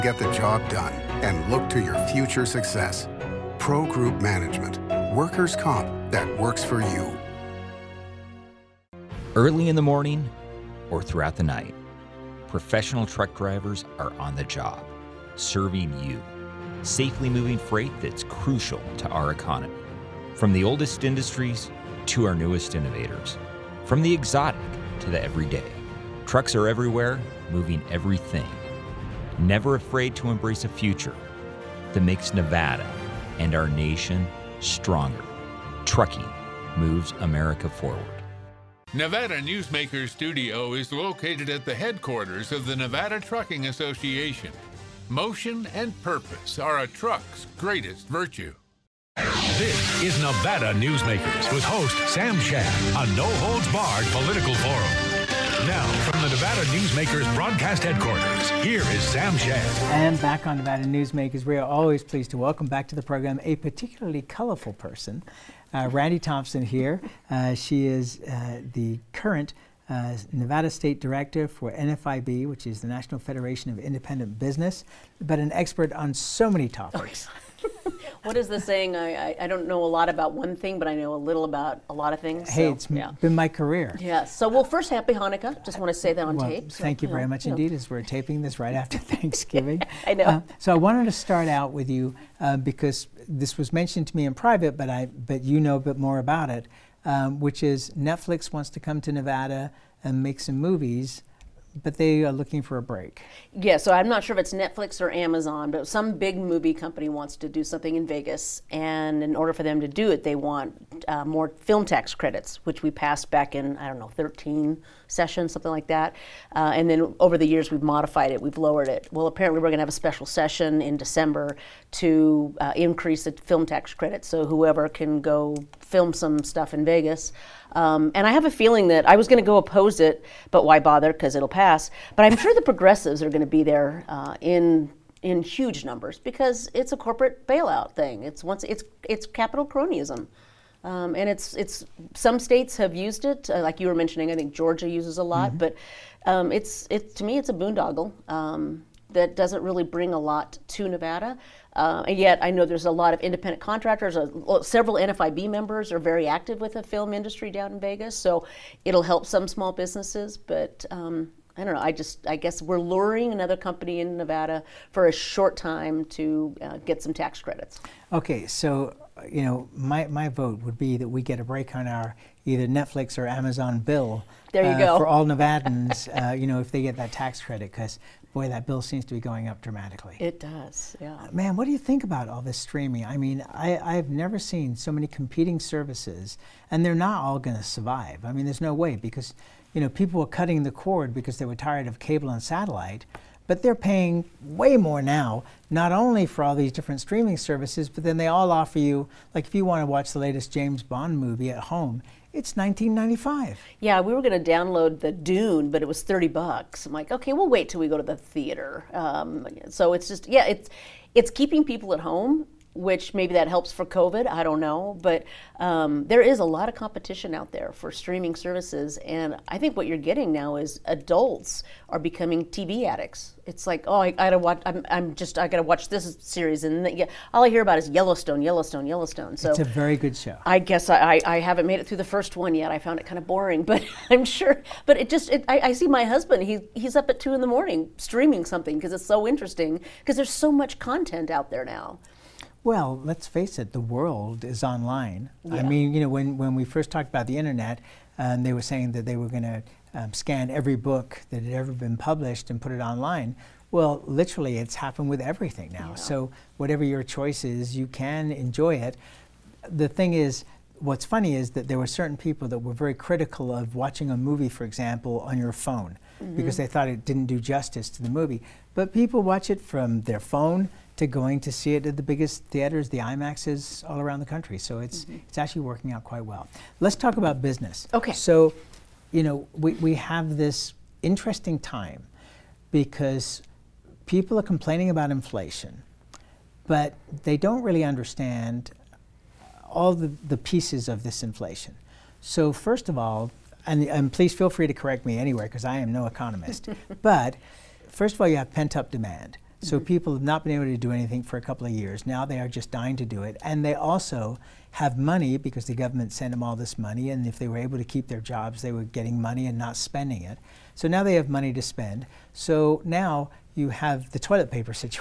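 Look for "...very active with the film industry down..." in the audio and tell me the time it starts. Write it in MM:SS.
02:36.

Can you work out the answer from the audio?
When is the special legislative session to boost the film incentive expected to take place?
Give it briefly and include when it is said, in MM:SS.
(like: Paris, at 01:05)
December, at 02:00.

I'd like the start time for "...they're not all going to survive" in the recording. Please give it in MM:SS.
03:06.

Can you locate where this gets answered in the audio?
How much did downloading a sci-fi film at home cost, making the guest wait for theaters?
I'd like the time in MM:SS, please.
03:26.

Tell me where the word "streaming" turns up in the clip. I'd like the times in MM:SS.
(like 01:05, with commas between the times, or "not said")
03:02, 03:17, 03:37, 03:57.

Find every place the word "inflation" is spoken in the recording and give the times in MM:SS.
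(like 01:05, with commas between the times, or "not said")
04:45, 04:51.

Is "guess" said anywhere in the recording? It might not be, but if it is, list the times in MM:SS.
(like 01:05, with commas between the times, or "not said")
02:42, 03:50.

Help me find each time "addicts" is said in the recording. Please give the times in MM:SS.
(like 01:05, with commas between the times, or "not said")
03:42.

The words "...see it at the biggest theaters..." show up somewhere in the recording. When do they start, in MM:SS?
04:31.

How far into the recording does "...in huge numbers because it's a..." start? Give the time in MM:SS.
02:15.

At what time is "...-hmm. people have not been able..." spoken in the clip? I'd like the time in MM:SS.
04:59.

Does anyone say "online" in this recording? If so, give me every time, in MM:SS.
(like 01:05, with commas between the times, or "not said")
04:04, 04:12.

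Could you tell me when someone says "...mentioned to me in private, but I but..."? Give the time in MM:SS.
01:33.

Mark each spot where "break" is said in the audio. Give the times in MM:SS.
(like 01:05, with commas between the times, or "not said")
01:42, 02:51.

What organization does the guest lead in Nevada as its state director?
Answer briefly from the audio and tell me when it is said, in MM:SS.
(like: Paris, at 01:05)
National Federation of Independent Business, at 01:12.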